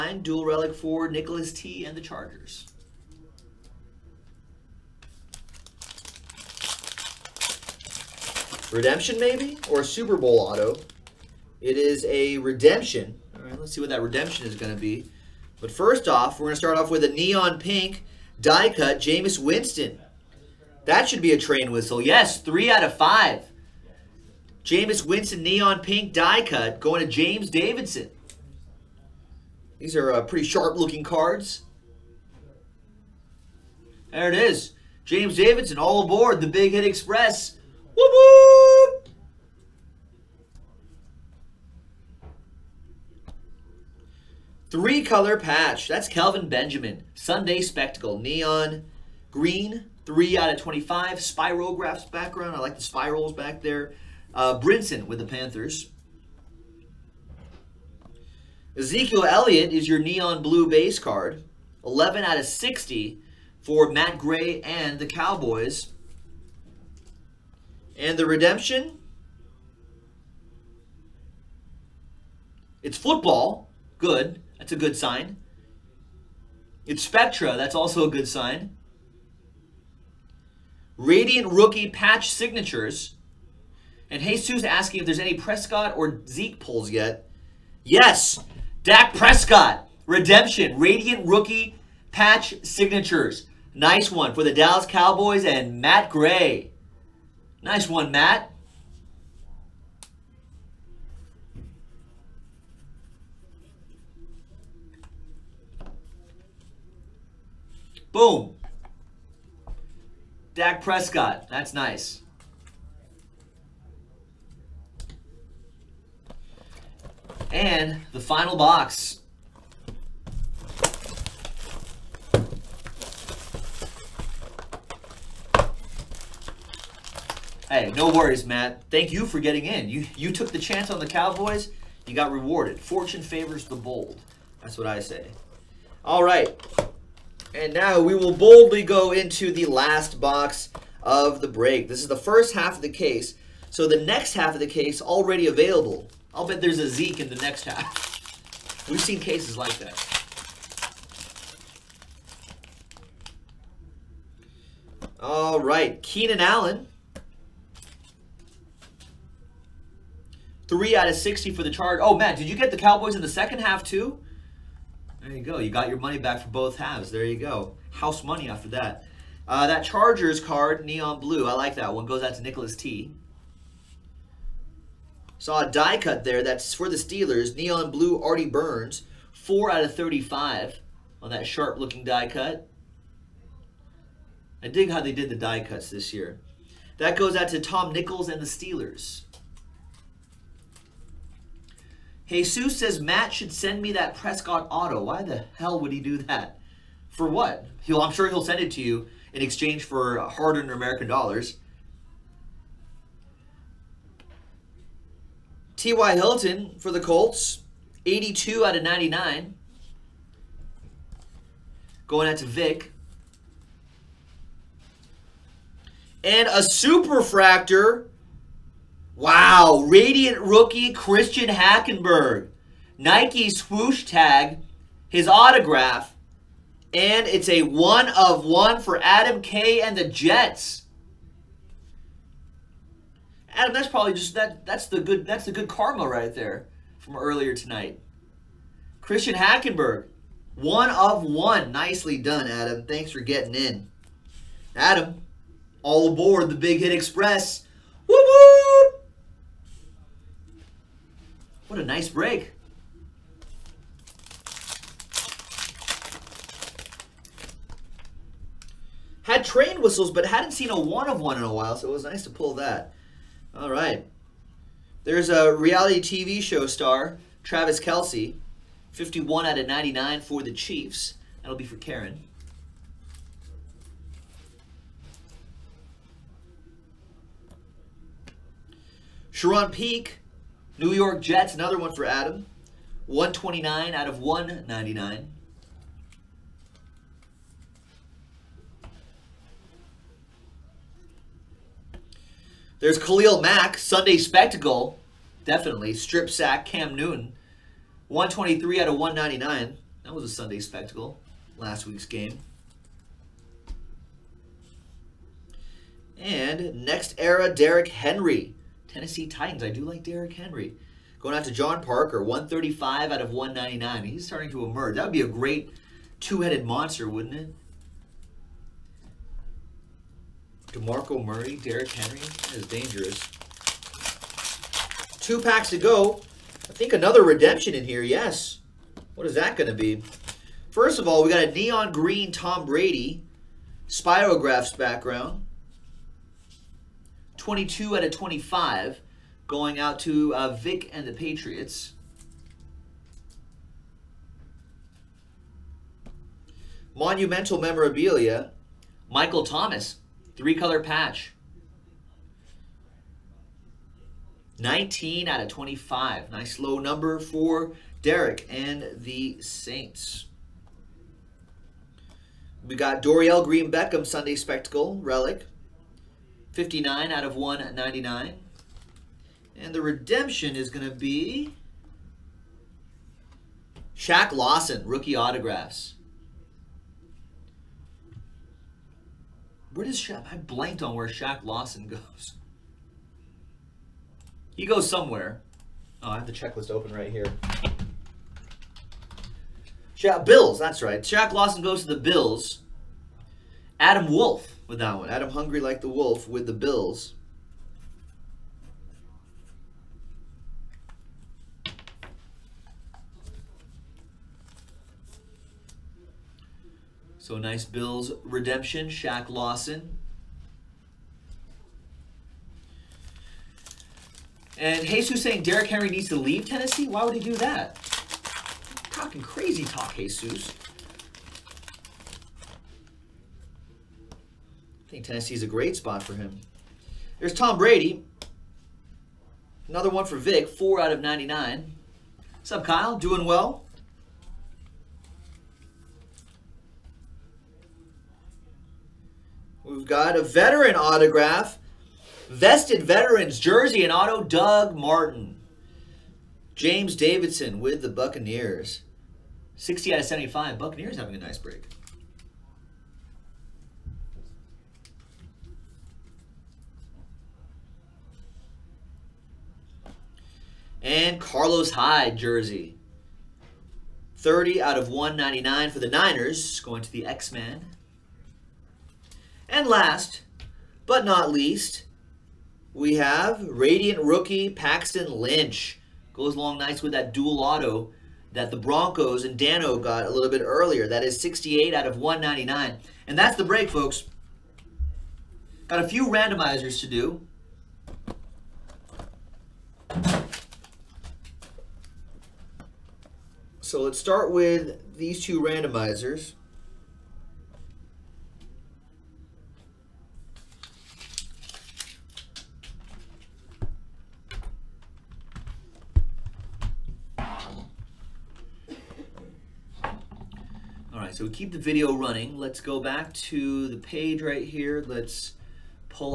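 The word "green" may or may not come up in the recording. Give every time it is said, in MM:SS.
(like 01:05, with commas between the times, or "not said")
00:49, 05:31, 06:03.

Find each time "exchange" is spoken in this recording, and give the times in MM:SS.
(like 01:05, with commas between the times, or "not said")
03:19.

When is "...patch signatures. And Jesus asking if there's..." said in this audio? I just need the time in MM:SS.
01:21.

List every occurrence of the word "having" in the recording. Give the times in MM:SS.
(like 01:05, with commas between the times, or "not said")
07:30.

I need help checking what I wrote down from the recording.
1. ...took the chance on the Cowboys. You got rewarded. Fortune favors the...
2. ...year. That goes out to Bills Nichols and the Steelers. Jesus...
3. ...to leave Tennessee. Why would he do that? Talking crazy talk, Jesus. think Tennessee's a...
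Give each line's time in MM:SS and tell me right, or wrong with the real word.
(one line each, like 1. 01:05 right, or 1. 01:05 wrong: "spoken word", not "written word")
1. 02:10 right
2. 03:06 wrong: "Tom", not "Bills"
3. 06:56 right.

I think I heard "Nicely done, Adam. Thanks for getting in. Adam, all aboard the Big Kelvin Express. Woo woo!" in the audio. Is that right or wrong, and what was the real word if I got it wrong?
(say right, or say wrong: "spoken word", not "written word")
wrong: "Hit", not "Kelvin".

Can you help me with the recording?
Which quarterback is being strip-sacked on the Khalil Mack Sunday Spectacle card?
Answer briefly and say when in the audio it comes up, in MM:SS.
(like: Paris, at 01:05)
Cam Newton, at 04:56.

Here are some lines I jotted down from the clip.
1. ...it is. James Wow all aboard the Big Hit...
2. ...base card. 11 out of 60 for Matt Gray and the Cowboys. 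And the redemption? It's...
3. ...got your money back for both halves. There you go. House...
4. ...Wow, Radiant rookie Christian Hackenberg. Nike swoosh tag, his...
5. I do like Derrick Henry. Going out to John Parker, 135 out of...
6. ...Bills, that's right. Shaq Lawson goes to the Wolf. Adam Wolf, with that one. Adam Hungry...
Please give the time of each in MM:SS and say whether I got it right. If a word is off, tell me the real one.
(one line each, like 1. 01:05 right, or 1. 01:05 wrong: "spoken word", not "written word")
1. 00:34 wrong: "Davidson", not "Wow"
2. 01:00 right
3. 02:45 right
4. 03:39 right
5. 05:09 right
6. 06:30 wrong: "Bills", not "Wolf".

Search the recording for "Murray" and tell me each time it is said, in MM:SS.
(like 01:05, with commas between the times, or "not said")
05:21.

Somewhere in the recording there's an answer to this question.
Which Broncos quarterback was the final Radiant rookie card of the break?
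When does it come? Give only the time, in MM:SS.
07:54.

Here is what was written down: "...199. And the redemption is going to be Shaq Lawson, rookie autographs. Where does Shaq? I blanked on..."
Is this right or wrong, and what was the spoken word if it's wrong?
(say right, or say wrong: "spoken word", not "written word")
right.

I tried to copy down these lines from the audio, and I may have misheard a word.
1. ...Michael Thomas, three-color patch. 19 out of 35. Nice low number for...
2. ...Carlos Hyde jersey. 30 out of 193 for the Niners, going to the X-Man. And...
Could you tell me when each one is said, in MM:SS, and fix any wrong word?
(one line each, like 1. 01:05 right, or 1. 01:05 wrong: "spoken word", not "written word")
1. 05:49 wrong: "25", not "35"
2. 07:41 wrong: "199", not "193".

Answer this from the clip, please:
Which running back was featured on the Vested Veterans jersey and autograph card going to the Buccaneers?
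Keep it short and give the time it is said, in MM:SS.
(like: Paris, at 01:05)
Doug Martin, at 07:24.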